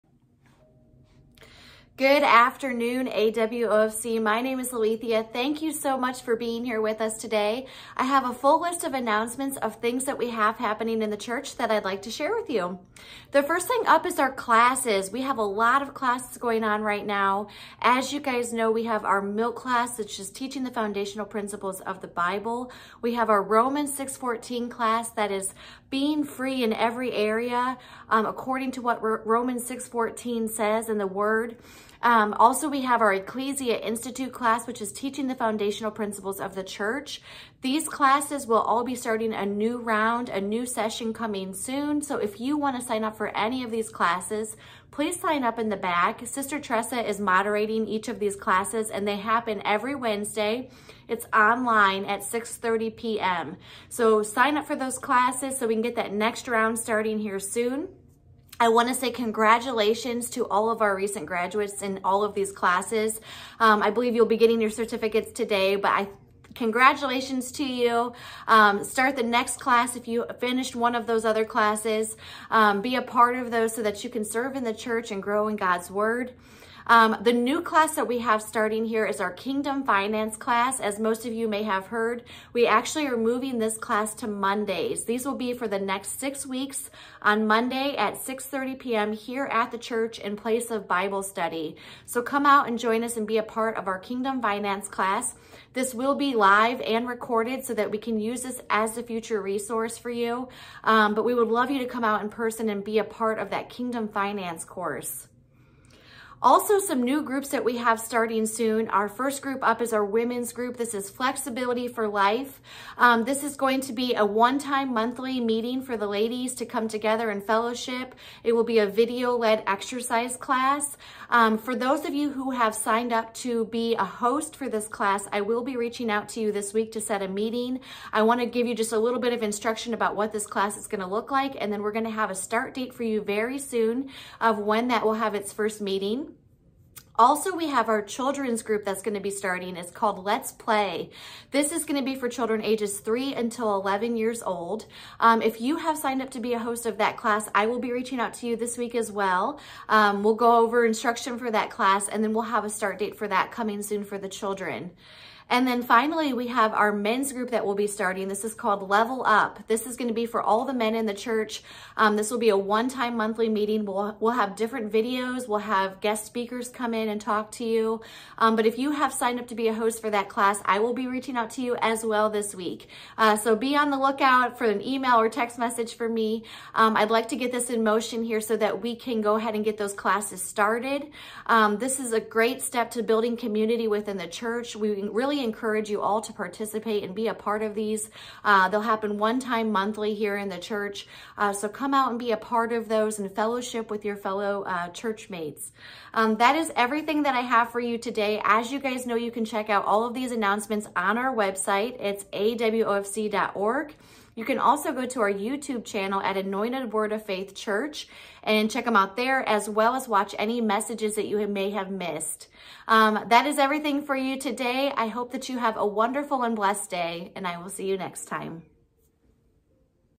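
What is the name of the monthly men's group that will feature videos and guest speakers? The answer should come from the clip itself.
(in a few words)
Level Up.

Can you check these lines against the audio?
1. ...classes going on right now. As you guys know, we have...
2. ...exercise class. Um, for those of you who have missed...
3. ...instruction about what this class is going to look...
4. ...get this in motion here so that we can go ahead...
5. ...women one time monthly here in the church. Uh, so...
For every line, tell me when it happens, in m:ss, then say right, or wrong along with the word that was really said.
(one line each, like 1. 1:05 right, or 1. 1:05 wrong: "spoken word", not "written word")
1. 0:15 right
2. 1:59 wrong: "signed", not "missed"
3. 2:09 right
4. 2:57 right
5. 3:08 wrong: "happen", not "women".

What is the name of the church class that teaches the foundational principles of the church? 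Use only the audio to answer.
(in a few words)
Ecclesia Institute.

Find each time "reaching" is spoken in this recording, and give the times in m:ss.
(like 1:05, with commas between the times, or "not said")
2:05, 2:27, 2:51.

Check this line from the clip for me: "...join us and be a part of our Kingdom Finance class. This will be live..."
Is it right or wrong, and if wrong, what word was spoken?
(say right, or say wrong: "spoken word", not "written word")
right.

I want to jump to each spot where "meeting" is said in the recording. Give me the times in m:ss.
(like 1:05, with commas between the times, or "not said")
1:55, 2:07, 2:15, 2:43.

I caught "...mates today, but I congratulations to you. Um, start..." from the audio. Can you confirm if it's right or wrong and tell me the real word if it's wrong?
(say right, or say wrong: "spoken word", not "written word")
wrong: "certificates", not "mates".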